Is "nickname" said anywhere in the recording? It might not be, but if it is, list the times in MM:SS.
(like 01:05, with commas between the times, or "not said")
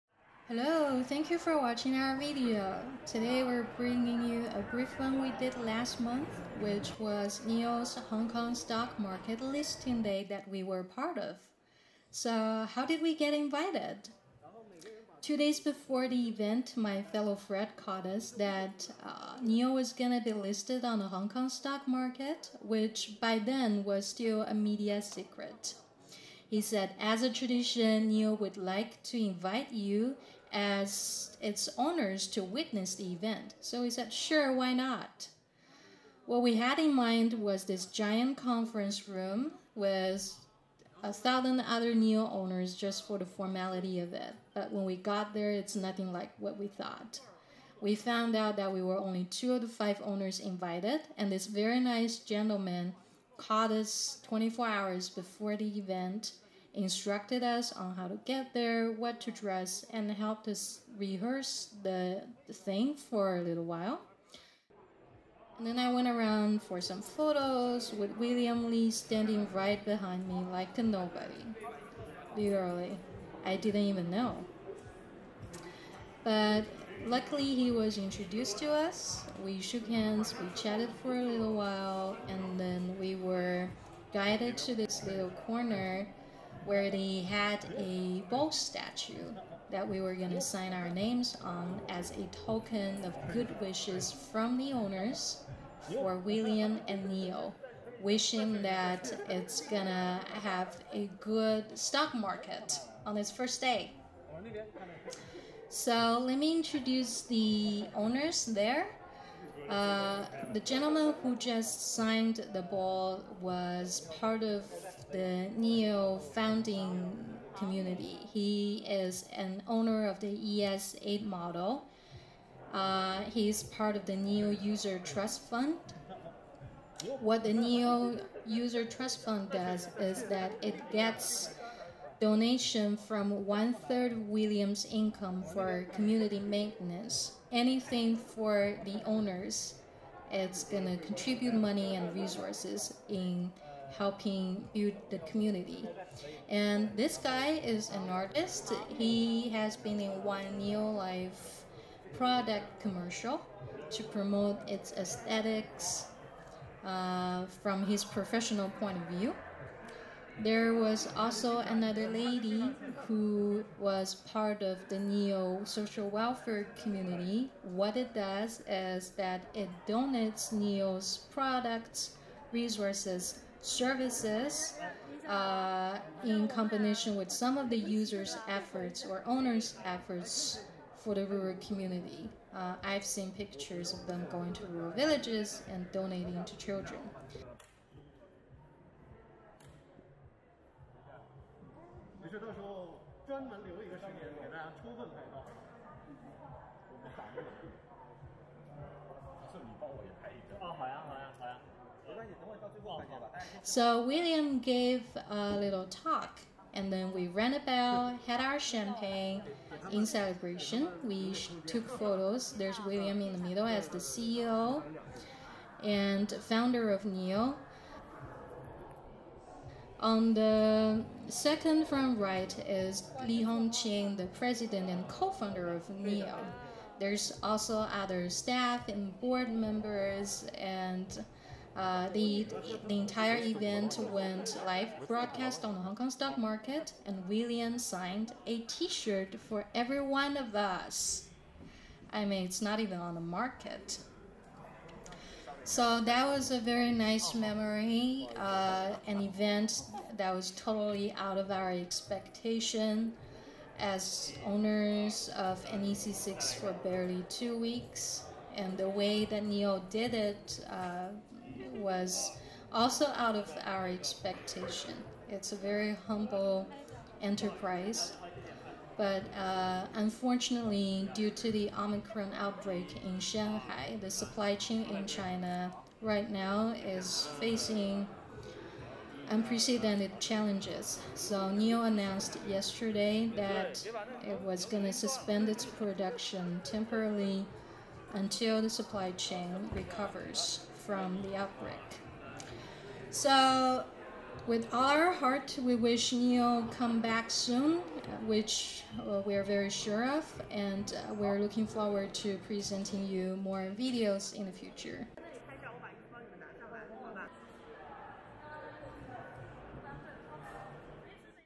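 not said.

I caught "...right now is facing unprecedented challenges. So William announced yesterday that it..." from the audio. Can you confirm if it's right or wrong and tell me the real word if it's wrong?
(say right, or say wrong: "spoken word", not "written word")
wrong: "NIO", not "William".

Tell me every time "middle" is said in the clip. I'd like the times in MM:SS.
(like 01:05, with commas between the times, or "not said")
03:33.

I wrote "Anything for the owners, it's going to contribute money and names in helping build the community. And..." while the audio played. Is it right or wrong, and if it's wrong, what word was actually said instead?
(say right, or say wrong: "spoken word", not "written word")
wrong: "resources", not "names".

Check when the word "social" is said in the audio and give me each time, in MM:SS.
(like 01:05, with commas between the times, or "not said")
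02:45.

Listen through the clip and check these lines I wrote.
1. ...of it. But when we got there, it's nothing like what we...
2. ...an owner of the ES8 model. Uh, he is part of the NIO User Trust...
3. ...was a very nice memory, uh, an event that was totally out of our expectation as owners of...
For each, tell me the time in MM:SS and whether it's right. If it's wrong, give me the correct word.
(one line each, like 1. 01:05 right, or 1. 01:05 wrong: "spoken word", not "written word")
1. 00:44 right
2. 01:59 right
3. 04:06 right.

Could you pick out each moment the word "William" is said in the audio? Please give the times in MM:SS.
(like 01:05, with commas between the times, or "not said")
01:08, 01:36, 02:14, 03:24, 03:32, 03:57.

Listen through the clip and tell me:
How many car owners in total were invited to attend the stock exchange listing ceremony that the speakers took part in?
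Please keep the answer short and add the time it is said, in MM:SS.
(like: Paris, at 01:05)
5, at 00:49.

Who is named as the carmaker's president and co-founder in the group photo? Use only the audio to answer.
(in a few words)
Li Hongqing.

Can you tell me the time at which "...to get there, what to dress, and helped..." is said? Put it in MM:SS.
00:58.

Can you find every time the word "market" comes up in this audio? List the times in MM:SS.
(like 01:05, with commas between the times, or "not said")
00:08, 00:21, 01:42, 03:56, 04:03.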